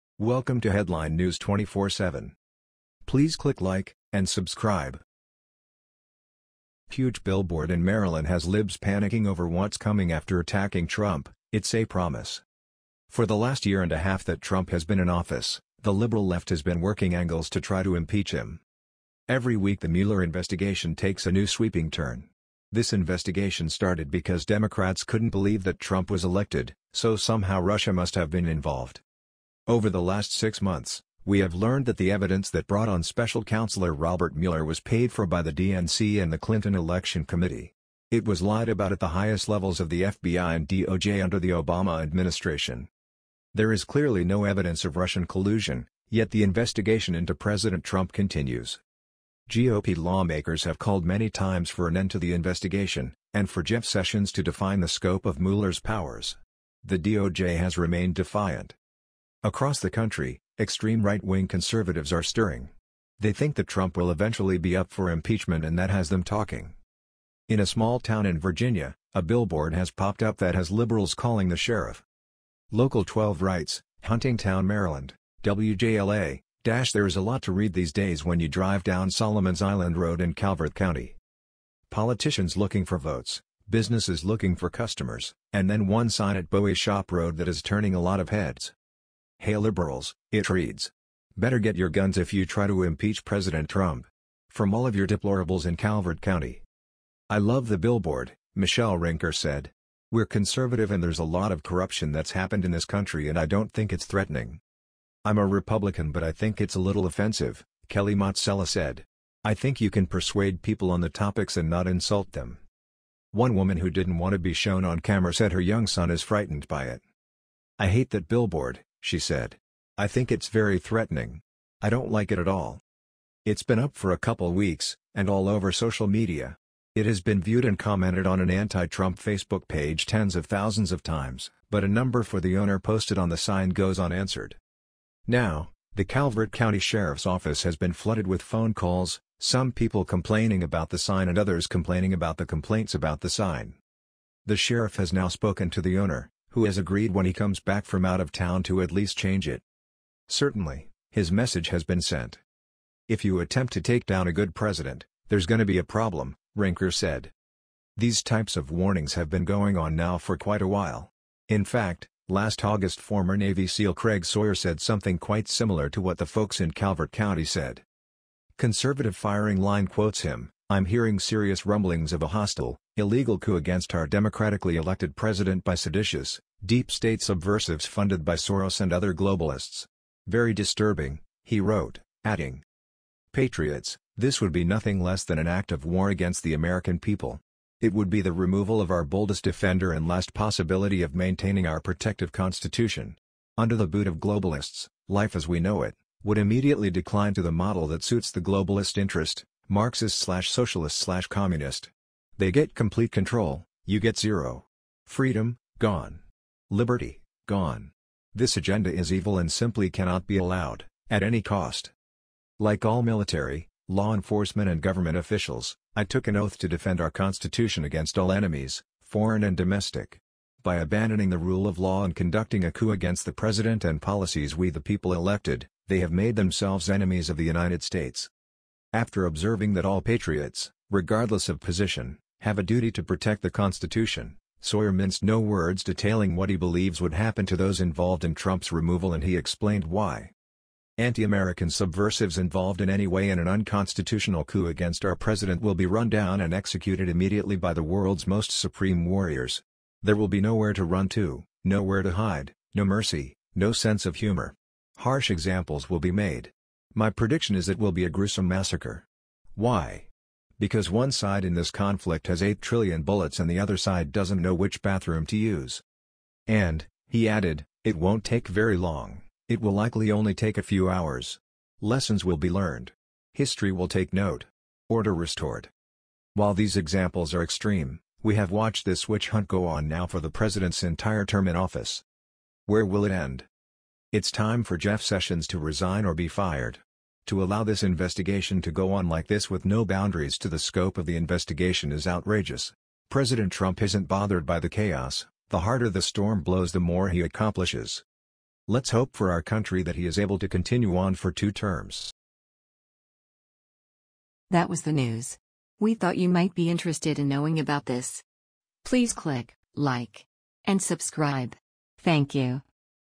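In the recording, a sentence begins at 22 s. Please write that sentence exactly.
This investigation started because Democrats couldn't believe that Trump was elected, so somehow Russia must have been involved.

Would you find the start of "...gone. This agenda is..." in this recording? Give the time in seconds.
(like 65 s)
207 s.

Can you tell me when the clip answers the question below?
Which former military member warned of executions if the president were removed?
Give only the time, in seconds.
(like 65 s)
163 s.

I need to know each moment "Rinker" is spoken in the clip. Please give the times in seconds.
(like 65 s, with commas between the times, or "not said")
98 s, 156 s.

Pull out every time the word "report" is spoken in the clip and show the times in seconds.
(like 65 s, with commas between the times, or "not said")
not said.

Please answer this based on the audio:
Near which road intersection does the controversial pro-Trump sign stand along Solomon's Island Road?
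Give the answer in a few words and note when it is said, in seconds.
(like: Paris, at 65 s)
Bowie Shop Road, at 86 s.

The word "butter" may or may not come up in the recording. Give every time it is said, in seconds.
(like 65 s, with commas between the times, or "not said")
not said.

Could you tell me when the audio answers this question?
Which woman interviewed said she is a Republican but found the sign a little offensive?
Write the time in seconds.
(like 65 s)
107 s.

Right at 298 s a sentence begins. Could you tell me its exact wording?
Let's hope for our country that he is able to continue on for two terms.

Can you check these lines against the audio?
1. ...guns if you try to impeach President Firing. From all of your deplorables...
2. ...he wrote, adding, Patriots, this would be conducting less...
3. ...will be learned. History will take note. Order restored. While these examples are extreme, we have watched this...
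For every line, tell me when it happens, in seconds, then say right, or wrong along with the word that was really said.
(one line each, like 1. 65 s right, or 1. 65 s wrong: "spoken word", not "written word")
1. 91 s wrong: "Trump", not "Firing"
2. 181 s wrong: "nothing", not "conducting"
3. 272 s right.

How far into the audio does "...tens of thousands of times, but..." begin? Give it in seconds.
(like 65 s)
130 s.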